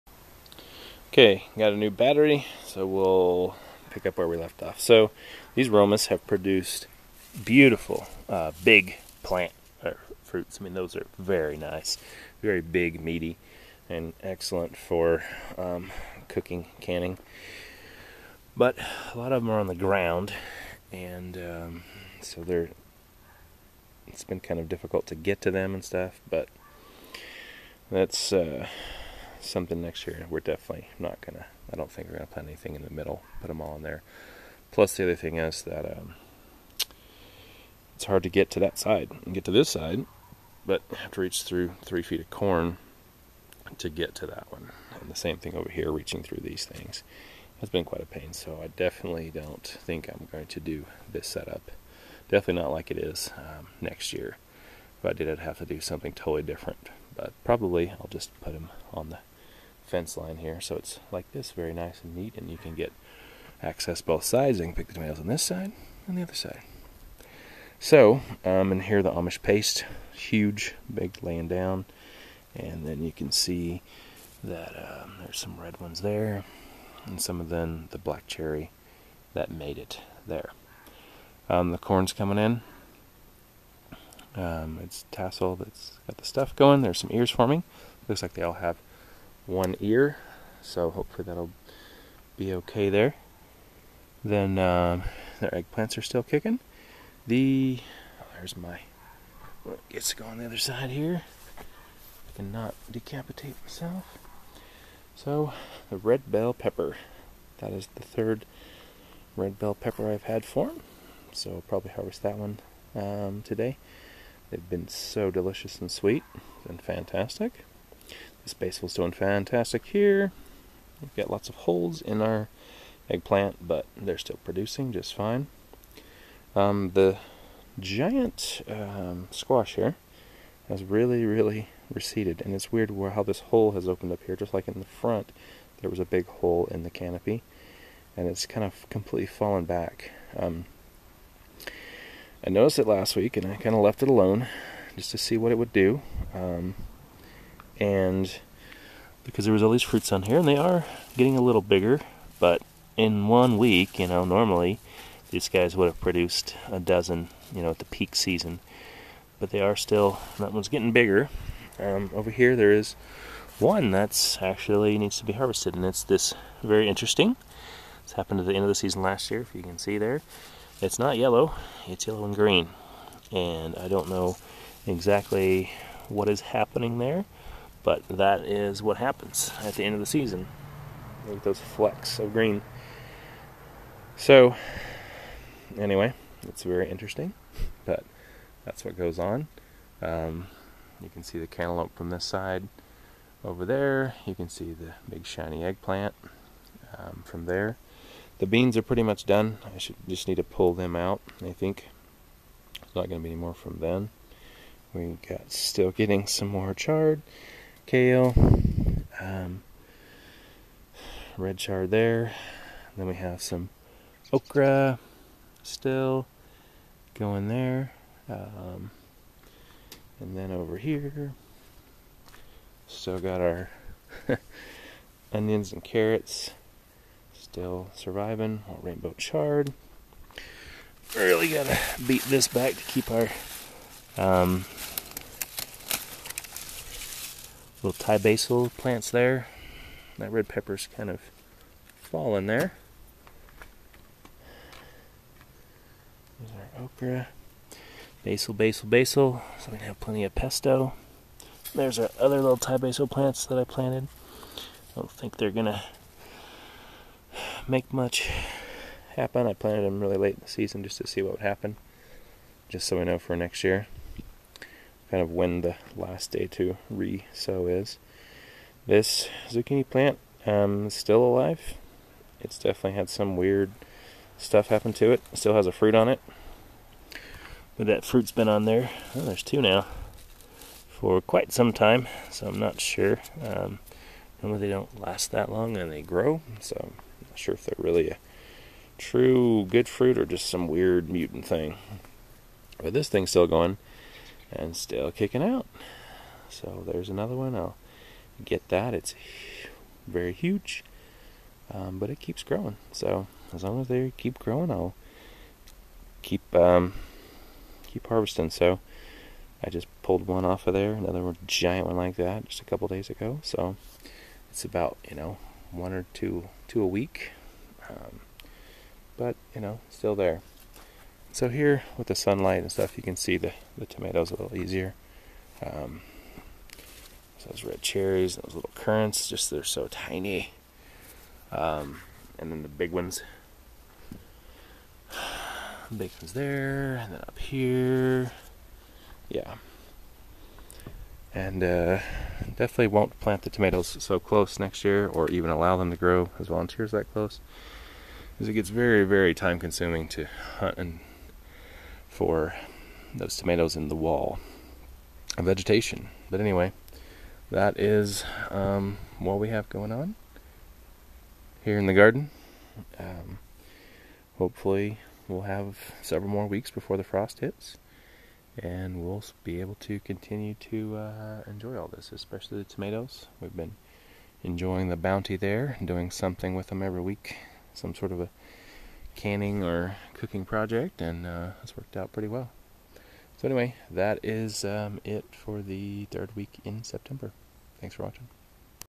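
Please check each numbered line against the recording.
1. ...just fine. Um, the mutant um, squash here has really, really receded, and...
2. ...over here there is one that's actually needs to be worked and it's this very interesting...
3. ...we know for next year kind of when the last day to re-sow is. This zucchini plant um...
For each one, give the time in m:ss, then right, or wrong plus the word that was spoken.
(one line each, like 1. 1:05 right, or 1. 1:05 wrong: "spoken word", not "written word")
1. 2:04 wrong: "giant", not "mutant"
2. 2:42 wrong: "harvested", not "worked"
3. 4:22 right.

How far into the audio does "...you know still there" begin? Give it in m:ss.
5:19.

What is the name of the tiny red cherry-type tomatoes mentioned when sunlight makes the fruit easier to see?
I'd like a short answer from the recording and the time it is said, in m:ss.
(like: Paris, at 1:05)
Currants, at 5:28.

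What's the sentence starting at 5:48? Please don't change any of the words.
Because it gets very, very time consuming to hunt and for those tomatoes in the wall of vegetation.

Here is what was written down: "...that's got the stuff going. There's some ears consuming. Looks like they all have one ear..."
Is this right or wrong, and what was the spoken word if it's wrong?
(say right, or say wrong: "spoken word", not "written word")
wrong: "forming", not "consuming".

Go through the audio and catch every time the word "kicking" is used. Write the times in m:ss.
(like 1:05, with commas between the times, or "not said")
1:36, 4:55.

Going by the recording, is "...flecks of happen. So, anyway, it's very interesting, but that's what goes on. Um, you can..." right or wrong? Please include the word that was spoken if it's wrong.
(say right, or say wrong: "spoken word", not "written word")
wrong: "green", not "happen".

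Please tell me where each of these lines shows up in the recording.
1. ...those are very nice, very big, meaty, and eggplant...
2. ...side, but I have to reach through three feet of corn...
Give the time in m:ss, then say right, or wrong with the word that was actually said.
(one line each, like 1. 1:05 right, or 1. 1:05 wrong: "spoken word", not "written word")
1. 0:10 wrong: "excellent", not "eggplant"
2. 0:39 right.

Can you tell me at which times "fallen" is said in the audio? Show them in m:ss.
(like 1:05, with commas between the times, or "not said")
2:19, 4:01.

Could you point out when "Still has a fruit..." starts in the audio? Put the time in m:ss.
4:35.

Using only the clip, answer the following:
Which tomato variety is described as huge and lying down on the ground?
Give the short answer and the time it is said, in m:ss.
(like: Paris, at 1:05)
Amish paste, at 1:09.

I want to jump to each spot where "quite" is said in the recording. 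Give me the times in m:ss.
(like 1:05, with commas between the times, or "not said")
0:47, 4:41.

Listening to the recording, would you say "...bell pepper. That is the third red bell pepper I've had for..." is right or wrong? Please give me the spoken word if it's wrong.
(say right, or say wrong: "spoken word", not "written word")
right.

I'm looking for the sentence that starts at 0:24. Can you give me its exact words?
It's been kind of difficult to get to them and stuff, but that's.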